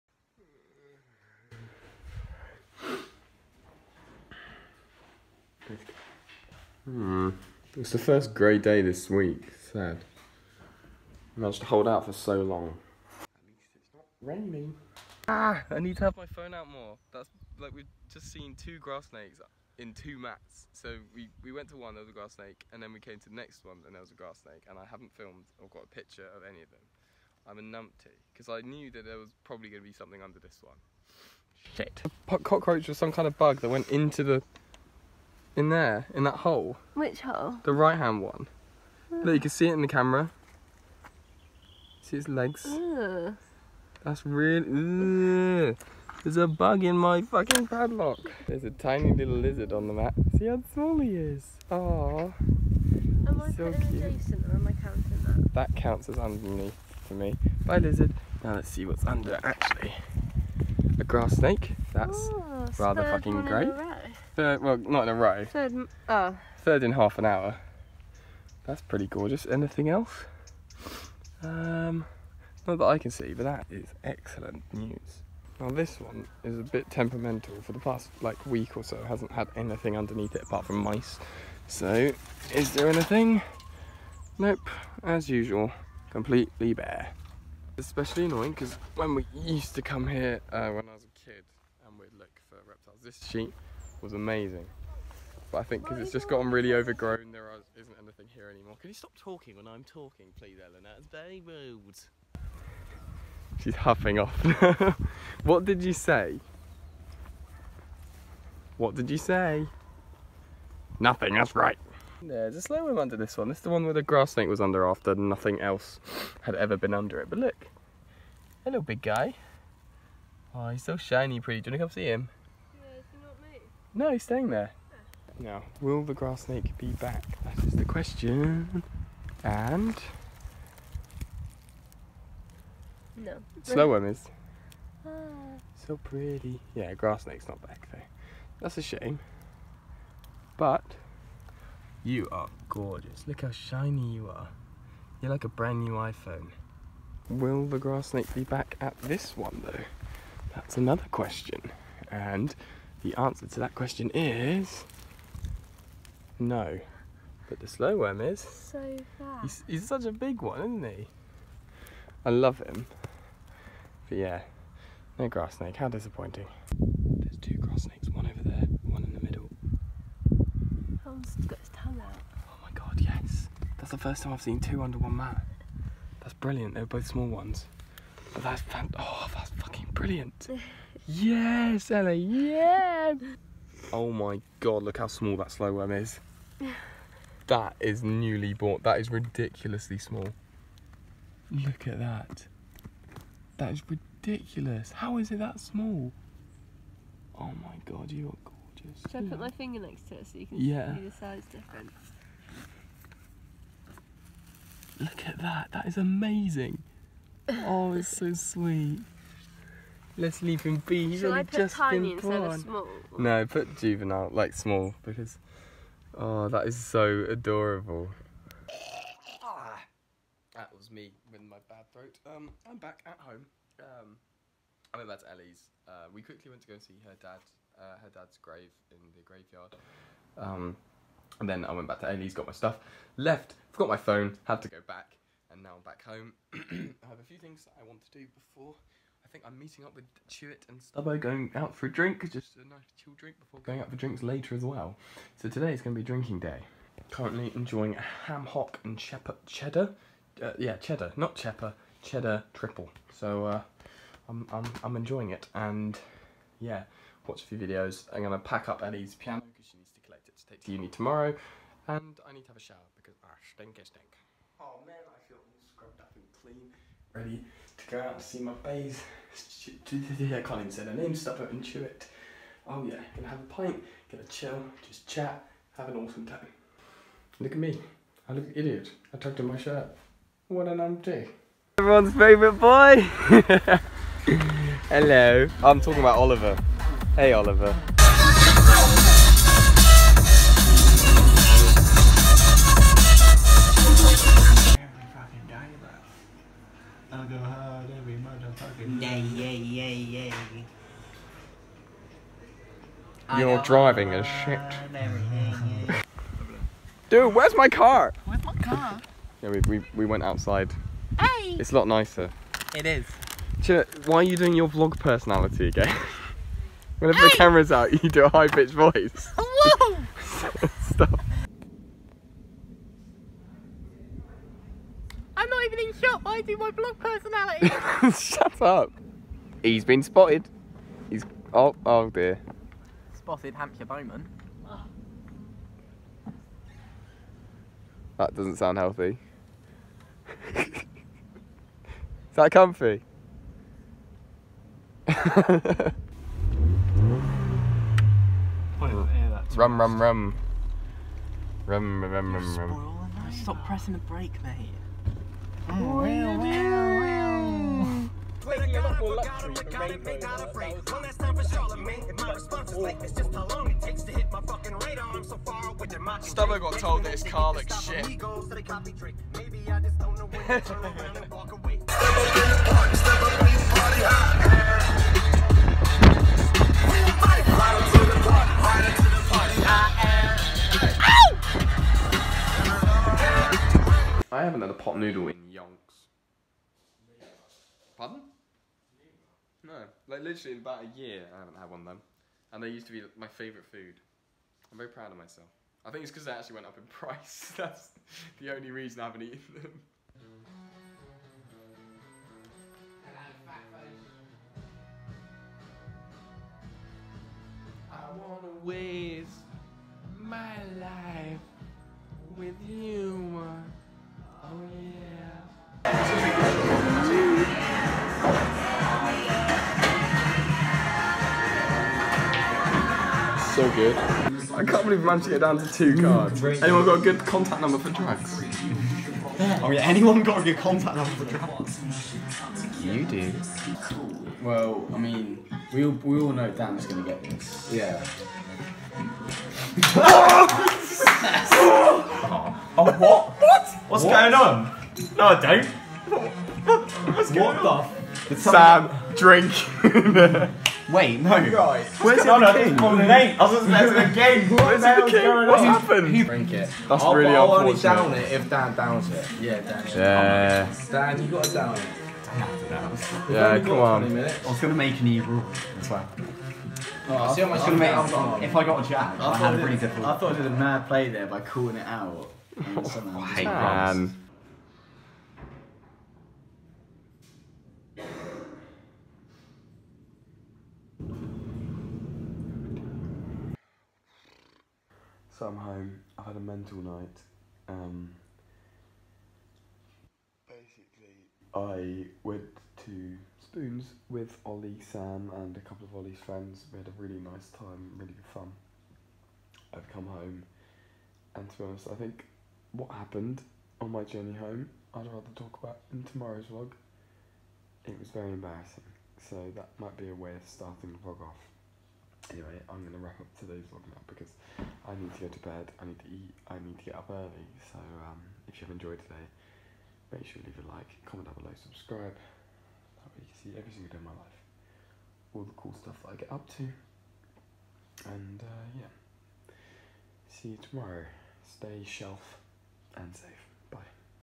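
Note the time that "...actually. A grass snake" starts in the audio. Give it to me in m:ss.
0:59.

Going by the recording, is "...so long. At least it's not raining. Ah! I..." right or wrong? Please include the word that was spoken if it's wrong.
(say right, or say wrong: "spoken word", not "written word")
right.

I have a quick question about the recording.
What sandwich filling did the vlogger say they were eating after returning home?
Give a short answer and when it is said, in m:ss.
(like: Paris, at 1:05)
ham hock and cheddar, at 4:08.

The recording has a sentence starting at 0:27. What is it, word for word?
I'm a numpty, because I knew that there was probably going to be something under this one.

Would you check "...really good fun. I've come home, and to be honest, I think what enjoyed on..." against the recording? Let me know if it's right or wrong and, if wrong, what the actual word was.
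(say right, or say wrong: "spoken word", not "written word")
wrong: "happened", not "enjoyed".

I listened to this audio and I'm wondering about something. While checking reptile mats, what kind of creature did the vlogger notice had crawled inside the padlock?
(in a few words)
a bug.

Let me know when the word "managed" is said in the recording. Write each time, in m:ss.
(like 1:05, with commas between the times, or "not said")
0:11, 7:05.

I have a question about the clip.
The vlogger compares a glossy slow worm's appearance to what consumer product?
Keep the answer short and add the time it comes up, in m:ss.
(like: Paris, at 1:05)
a brand new iPhone, at 2:25.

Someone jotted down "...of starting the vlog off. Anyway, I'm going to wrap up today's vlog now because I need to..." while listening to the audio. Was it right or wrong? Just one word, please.
right.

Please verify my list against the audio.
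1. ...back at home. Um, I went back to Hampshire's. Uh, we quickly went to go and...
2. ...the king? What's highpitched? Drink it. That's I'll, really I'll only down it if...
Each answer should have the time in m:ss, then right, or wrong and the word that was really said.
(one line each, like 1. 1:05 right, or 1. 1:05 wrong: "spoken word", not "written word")
1. 3:42 wrong: "Ellie", not "Hampshire"
2. 7:34 wrong: "happened", not "highpitched".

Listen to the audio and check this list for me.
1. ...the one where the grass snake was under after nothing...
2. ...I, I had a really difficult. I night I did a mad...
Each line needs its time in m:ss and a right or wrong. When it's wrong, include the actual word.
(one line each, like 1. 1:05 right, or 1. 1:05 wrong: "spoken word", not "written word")
1. 1:53 right
2. 7:49 wrong: "thought", not "night".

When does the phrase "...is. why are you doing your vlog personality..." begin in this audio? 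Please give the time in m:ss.
5:12.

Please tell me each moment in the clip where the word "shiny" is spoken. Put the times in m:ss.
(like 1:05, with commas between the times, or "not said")
2:00, 2:23.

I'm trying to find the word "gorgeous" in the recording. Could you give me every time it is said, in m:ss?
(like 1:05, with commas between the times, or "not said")
1:09, 2:22, 3:18.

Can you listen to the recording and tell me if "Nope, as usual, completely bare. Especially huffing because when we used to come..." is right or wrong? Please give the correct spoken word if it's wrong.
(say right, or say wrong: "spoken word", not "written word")
wrong: "annoying", not "huffing".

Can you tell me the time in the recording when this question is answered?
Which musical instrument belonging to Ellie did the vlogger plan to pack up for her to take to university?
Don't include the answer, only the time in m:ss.
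4:19.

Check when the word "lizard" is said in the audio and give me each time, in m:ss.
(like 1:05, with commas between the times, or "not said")
0:49, 0:57.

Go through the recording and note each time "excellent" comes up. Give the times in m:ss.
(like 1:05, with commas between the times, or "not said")
1:14.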